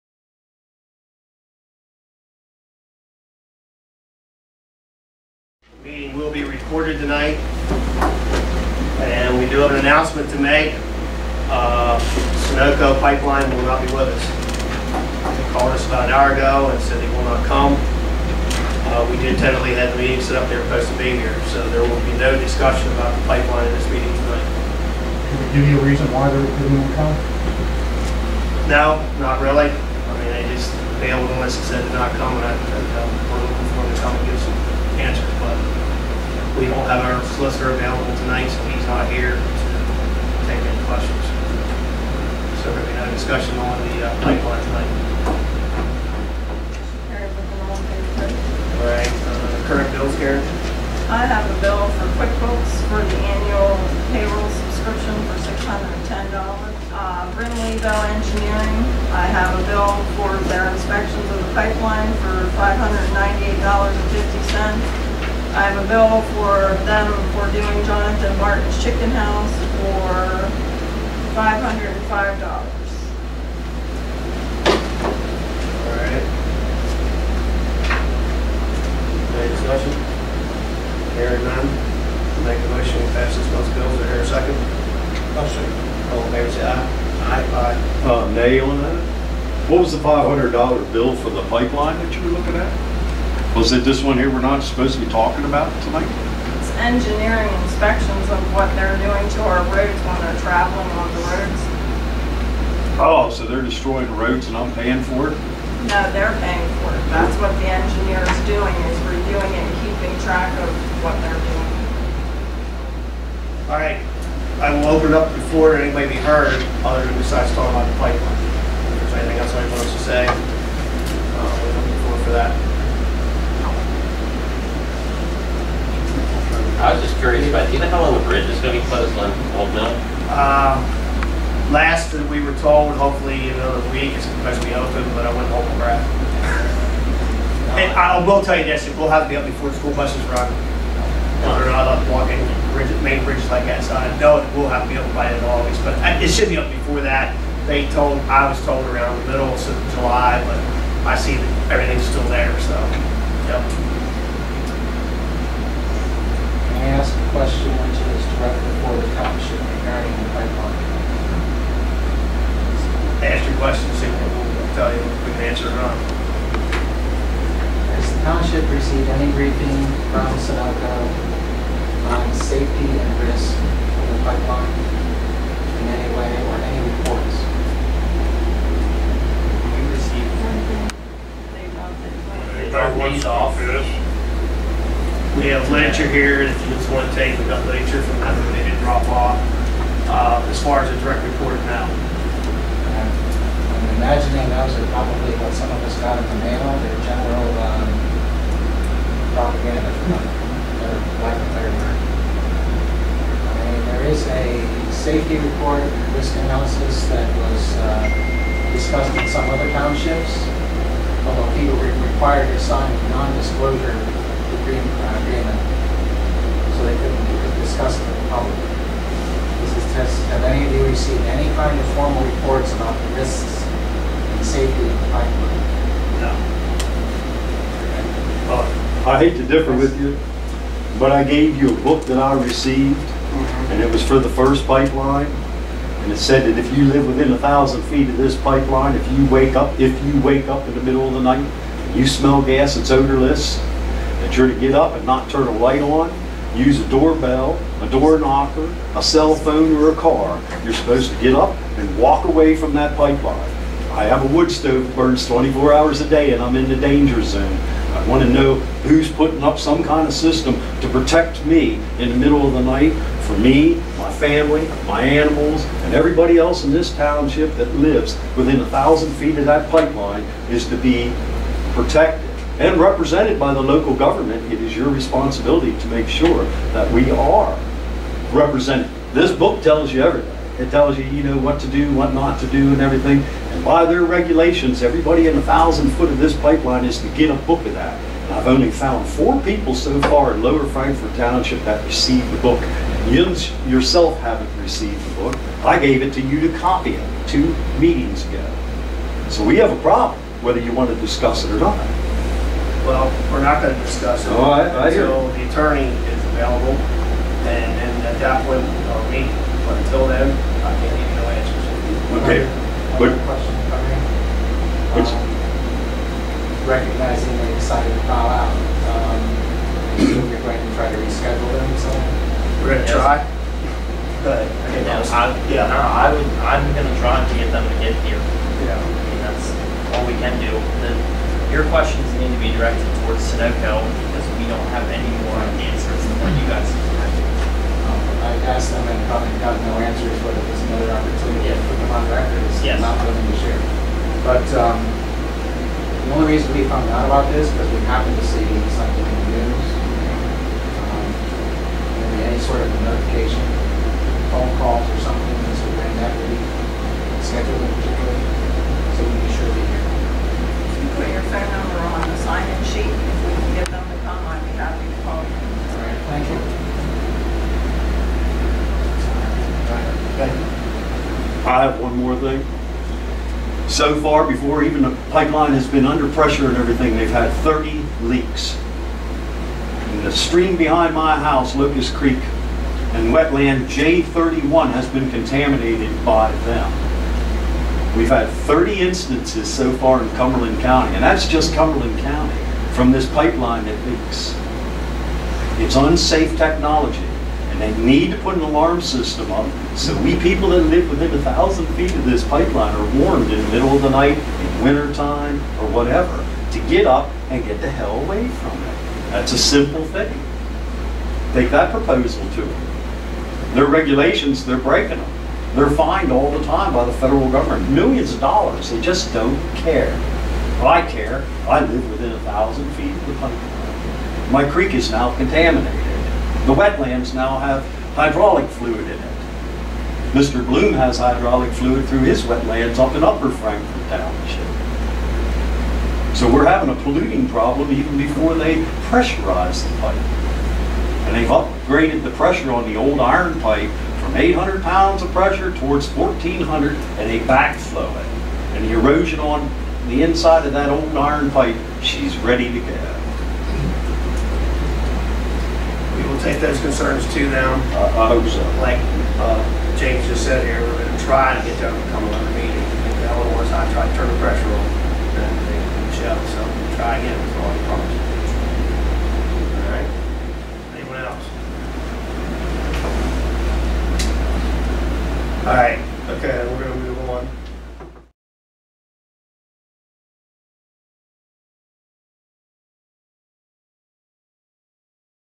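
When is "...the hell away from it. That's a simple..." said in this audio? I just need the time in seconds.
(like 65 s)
407 s.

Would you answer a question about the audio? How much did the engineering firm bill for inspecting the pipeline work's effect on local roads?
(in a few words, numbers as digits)
$598.50.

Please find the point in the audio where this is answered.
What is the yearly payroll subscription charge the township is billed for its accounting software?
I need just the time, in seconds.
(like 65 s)
55 s.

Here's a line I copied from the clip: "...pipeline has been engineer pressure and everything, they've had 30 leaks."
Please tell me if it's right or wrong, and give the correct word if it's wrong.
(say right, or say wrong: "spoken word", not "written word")
wrong: "under", not "engineer".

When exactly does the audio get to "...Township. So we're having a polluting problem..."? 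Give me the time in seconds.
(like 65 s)
433 s.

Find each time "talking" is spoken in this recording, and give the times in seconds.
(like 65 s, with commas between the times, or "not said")
95 s, 117 s.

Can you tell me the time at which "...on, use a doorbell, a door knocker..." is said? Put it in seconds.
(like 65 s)
245 s.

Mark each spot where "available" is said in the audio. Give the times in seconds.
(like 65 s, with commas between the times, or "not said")
37 s, 306 s.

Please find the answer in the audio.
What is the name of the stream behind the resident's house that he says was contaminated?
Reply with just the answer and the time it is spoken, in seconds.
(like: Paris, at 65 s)
Locust Creek, at 381 s.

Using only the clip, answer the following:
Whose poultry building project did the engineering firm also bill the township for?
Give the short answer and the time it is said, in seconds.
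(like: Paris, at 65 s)
Jonathan Martin, at 67 s.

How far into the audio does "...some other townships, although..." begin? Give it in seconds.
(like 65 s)
209 s.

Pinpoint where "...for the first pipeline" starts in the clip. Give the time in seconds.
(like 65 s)
234 s.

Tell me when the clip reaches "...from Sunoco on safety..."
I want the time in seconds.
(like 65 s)
170 s.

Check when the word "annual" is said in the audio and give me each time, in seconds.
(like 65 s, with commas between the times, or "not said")
53 s.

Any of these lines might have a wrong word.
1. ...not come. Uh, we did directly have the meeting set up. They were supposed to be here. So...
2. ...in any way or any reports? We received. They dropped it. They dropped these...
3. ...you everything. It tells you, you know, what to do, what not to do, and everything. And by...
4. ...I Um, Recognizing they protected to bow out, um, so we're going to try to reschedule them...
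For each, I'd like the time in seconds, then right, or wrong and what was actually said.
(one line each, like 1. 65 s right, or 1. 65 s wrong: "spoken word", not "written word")
1. 17 s wrong: "tentatively", not "directly"
2. 175 s right
3. 279 s right
4. 313 s wrong: "decided", not "protected".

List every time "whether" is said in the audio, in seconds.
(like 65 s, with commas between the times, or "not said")
141 s, 300 s.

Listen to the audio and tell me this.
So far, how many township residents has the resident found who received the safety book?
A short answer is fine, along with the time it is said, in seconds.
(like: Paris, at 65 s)
4, at 289 s.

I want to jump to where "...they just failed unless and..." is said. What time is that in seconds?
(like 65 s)
30 s.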